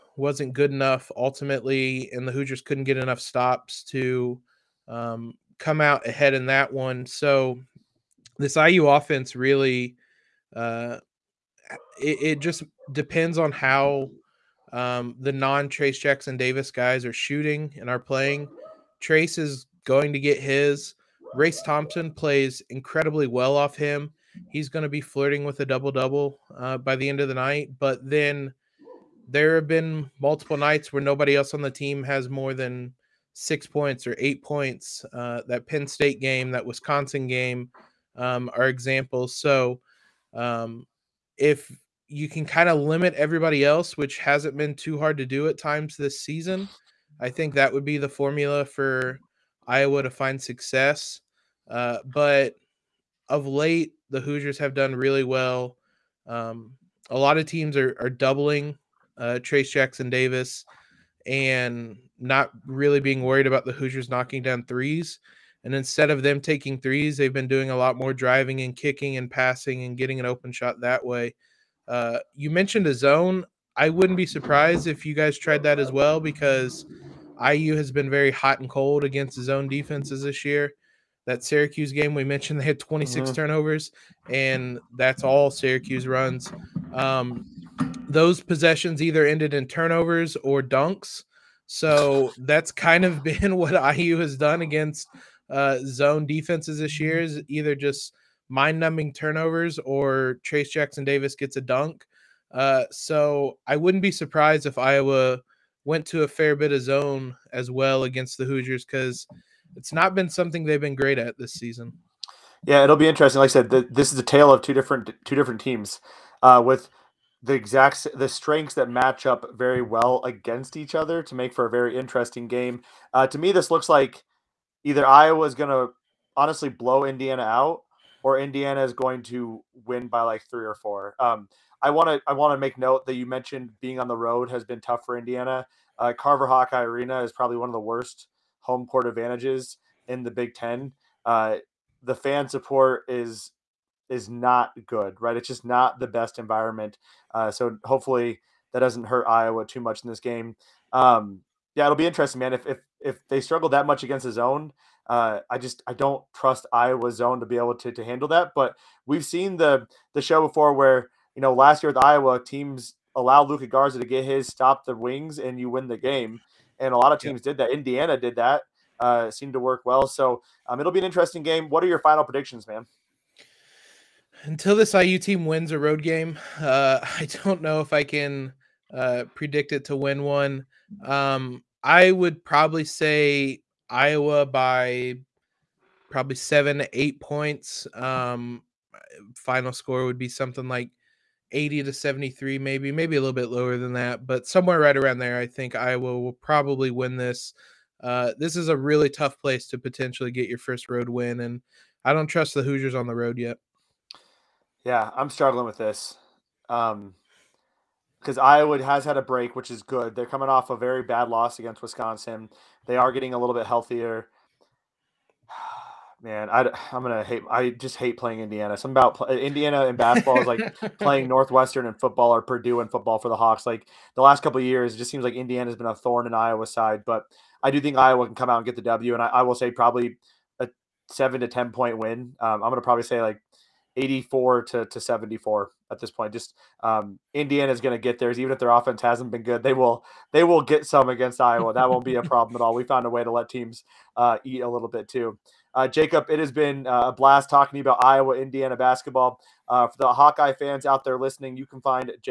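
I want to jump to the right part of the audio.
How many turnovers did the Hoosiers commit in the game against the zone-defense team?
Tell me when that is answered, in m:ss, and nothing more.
1:22.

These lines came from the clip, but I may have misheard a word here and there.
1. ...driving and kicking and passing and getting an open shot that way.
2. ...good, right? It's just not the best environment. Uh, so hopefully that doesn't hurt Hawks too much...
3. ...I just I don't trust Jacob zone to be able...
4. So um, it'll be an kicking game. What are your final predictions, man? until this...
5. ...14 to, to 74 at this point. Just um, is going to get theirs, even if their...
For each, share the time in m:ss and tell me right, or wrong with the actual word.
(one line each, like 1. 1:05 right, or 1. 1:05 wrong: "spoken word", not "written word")
1. 1:08 right
2. 2:24 wrong: "Iowa", not "Hawks"
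3. 2:35 wrong: "Iowa", not "Jacob"
4. 2:50 wrong: "interesting", not "kicking"
5. 3:53 wrong: "84", not "14".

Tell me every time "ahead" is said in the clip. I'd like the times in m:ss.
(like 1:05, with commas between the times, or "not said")
0:06.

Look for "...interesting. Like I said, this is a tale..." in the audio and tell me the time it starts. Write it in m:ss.
1:53.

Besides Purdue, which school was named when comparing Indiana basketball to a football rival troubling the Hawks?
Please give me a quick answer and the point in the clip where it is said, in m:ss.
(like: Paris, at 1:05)
Northwestern, at 3:41.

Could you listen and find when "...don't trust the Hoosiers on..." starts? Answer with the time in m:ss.
3:22.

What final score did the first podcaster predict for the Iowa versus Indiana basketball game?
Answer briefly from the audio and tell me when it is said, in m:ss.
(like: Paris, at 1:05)
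80 to 73, at 3:11.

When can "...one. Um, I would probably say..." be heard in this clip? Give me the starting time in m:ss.
3:00.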